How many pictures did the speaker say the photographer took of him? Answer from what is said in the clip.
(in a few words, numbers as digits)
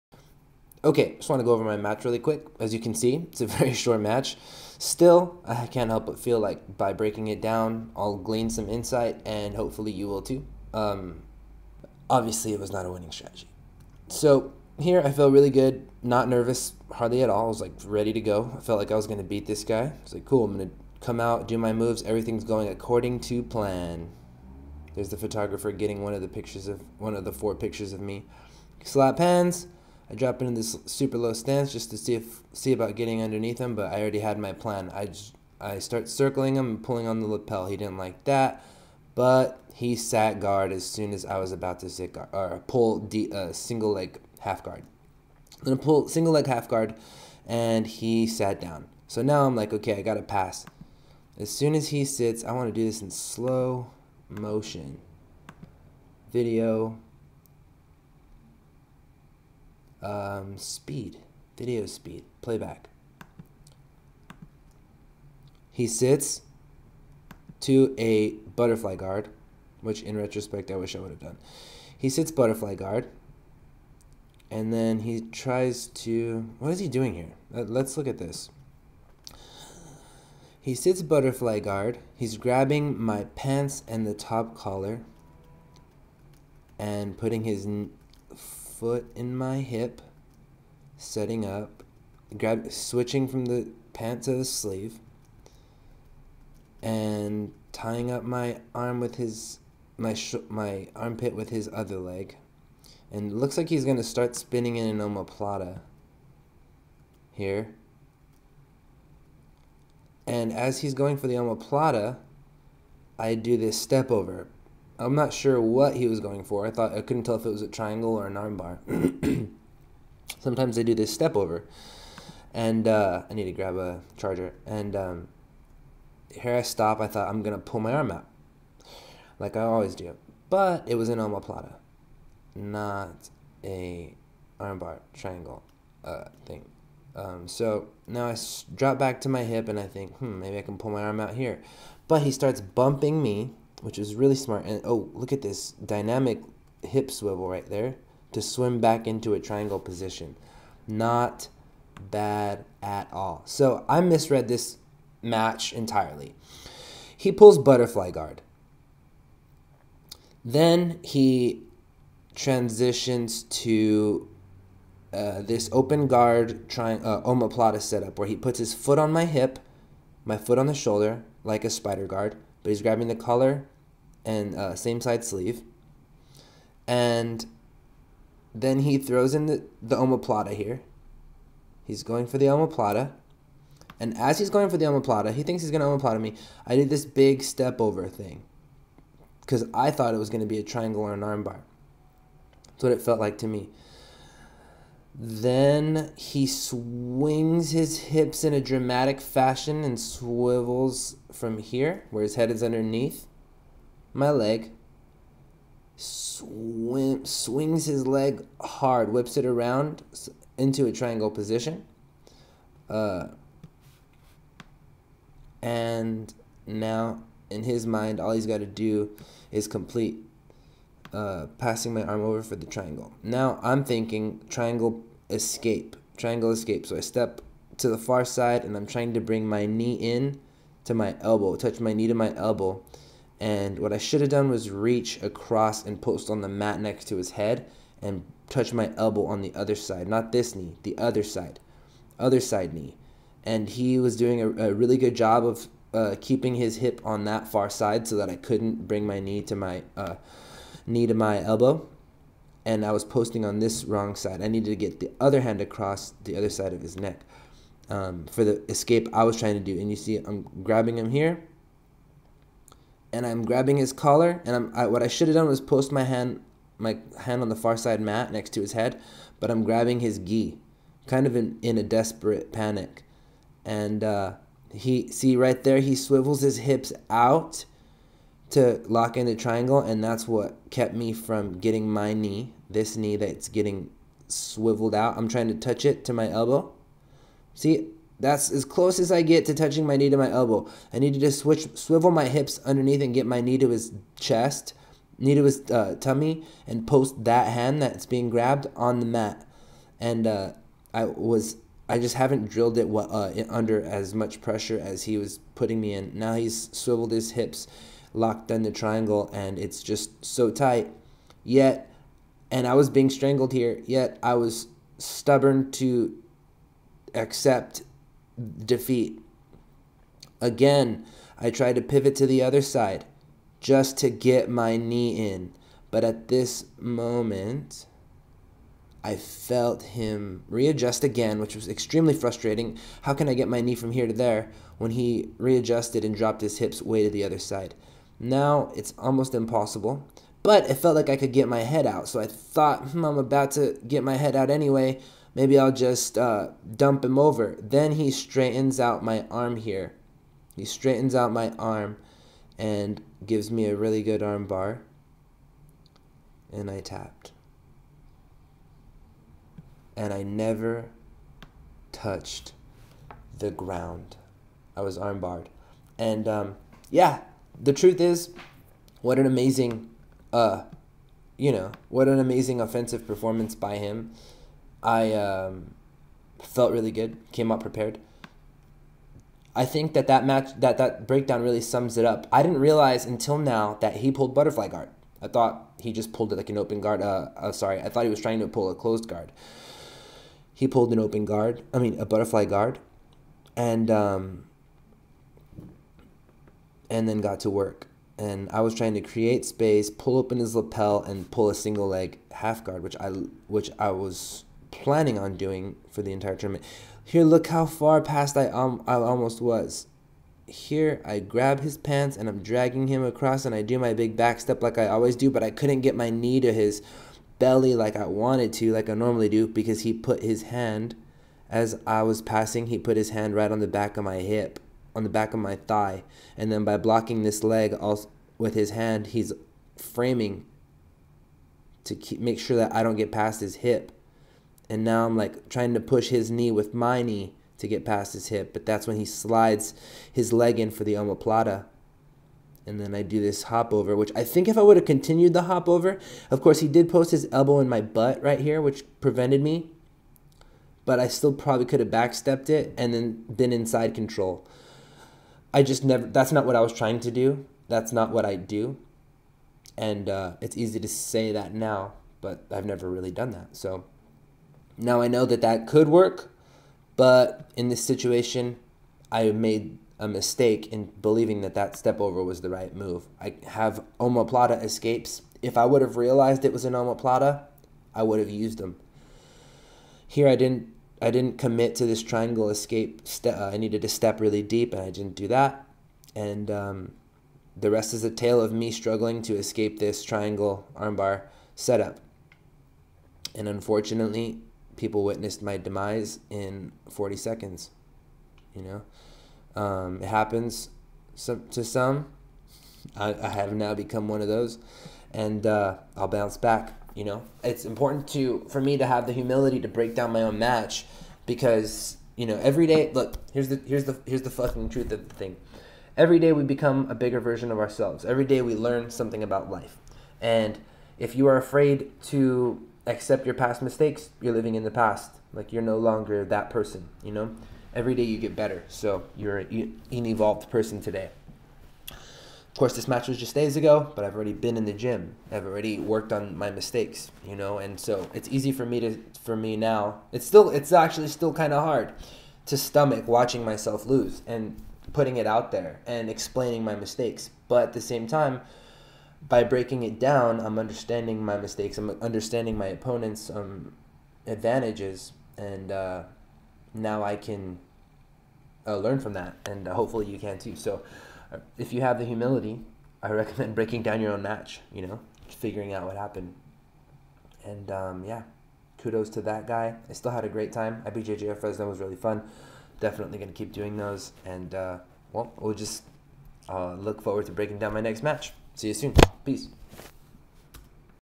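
4.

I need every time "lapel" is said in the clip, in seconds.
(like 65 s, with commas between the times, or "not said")
37 s, 400 s.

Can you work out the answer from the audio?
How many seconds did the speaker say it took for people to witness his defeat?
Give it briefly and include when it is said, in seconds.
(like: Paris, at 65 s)
40, at 496 s.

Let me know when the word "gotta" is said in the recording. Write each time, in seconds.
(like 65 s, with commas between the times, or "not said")
50 s.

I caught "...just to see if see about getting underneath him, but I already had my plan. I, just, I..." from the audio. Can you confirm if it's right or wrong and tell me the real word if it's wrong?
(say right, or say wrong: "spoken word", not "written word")
right.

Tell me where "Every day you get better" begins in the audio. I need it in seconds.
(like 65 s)
527 s.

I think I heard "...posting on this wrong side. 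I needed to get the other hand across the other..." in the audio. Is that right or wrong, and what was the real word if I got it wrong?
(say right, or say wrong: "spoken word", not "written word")
right.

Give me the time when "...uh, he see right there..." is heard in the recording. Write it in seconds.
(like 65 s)
274 s.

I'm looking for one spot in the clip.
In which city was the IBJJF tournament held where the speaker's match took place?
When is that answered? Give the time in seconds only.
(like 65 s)
571 s.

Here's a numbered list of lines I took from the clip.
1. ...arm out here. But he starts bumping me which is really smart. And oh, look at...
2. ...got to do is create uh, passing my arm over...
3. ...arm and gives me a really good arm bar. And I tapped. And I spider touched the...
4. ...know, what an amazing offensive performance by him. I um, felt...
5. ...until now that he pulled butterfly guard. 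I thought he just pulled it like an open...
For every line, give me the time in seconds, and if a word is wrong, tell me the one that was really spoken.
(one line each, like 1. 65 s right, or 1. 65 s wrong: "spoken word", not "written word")
1. 141 s right
2. 218 s wrong: "complete", not "create"
3. 351 s wrong: "never", not "spider"
4. 371 s right
5. 383 s right.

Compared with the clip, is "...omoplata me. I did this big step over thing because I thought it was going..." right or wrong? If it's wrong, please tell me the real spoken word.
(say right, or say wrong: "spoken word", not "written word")
right.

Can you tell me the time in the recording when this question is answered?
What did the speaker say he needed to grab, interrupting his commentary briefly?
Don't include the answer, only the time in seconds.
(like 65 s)
124 s.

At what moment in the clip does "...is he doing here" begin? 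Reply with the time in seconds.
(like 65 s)
76 s.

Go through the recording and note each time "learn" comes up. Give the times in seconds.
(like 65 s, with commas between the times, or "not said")
518 s, 558 s.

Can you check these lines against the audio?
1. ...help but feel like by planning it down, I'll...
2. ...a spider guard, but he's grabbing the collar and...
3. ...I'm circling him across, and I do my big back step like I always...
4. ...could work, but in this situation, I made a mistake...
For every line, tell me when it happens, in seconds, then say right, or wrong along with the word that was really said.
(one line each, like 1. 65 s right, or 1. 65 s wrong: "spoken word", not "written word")
1. 5 s wrong: "breaking", not "planning"
2. 171 s right
3. 412 s wrong: "dragging", not "circling"
4. 465 s right.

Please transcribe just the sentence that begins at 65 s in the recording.
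He sits to a butterfly guard, which in retrospect I wish I would have done.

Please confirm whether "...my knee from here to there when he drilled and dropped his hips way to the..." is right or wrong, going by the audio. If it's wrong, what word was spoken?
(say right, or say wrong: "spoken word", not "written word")
wrong: "readjusted", not "drilled".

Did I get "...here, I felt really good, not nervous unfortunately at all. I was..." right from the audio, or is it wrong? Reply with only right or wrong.
wrong.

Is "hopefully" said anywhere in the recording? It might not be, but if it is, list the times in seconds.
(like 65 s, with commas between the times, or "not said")
9 s, 559 s.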